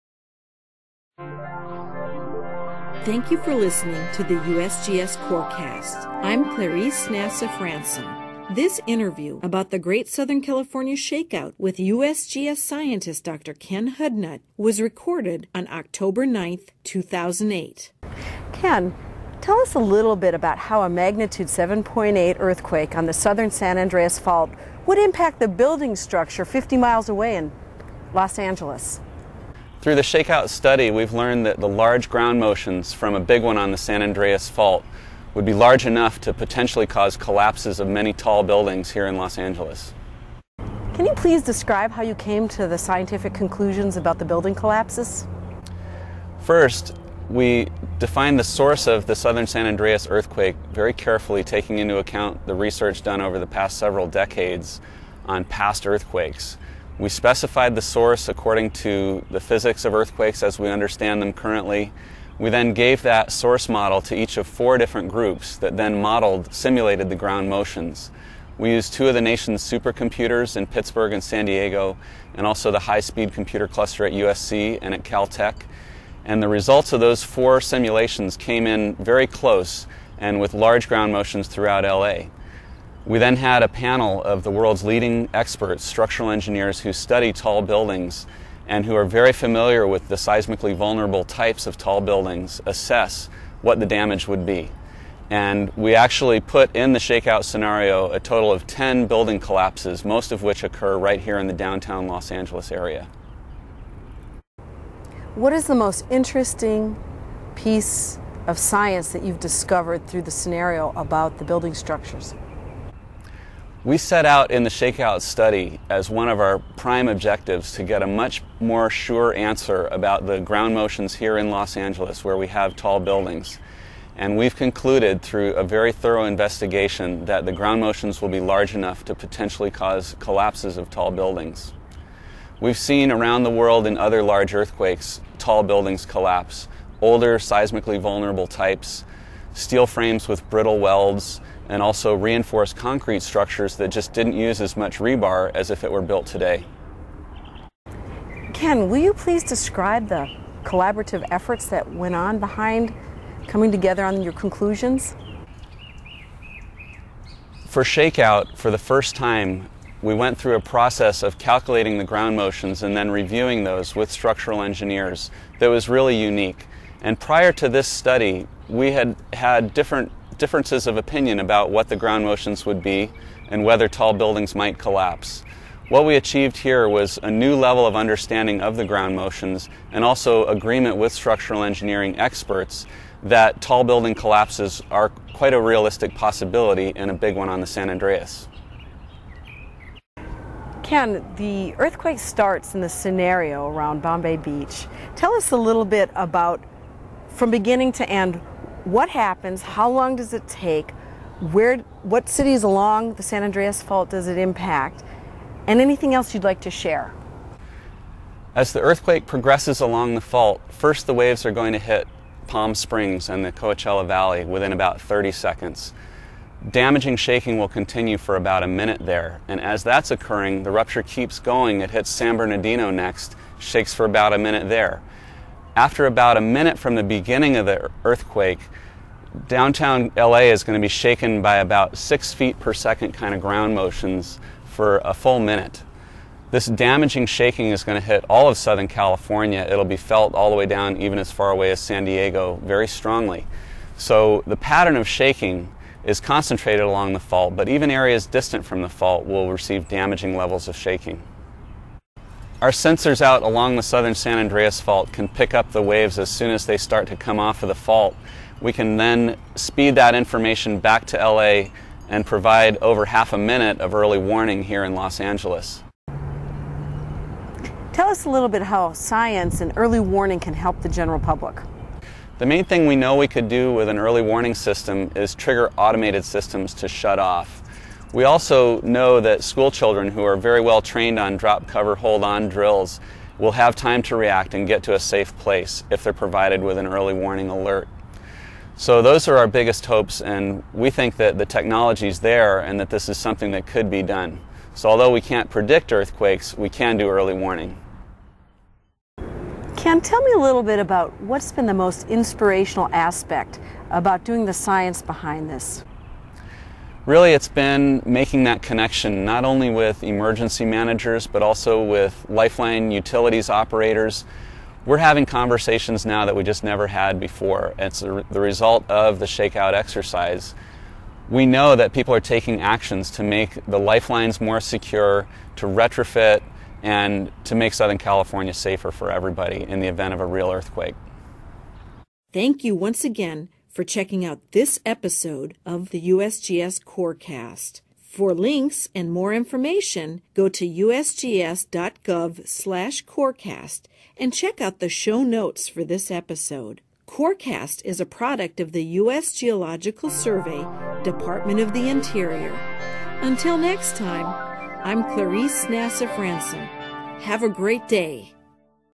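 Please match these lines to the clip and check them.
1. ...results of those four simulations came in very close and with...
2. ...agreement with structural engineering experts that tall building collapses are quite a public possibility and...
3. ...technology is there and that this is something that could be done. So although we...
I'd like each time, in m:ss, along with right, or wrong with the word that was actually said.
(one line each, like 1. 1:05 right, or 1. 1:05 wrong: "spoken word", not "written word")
1. 1:16 right
2. 3:00 wrong: "realistic", not "public"
3. 4:51 right.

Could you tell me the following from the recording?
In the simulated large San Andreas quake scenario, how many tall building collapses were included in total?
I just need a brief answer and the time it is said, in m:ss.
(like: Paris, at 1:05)
10, at 1:38.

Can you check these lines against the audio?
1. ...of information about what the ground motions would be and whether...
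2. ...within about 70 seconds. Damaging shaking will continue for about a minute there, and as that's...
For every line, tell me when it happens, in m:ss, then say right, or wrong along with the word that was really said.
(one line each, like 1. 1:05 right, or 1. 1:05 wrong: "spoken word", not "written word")
1. 2:50 wrong: "opinion", not "information"
2. 3:34 wrong: "30", not "70".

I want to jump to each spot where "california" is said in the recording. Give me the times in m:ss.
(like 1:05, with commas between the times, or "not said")
0:10, 3:58, 5:27.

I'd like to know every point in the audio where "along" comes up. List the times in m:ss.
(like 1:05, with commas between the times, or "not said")
3:22, 3:29, 4:06, 4:13.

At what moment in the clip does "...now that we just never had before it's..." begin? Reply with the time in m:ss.
5:16.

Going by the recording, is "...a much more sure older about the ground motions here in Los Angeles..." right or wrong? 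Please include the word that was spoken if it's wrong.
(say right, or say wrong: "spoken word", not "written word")
wrong: "answer", not "older".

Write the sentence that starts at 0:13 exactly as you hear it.
Ken Hudnut was recorded on October 9th, 2008.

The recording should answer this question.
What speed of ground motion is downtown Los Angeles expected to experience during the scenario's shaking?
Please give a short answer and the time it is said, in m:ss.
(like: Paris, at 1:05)
6 feet per second, at 3:51.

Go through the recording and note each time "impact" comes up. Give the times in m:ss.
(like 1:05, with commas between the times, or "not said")
0:24, 3:24.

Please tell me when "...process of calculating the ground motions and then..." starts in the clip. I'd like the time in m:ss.
2:40.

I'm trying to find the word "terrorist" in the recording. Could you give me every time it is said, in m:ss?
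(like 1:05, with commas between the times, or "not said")
not said.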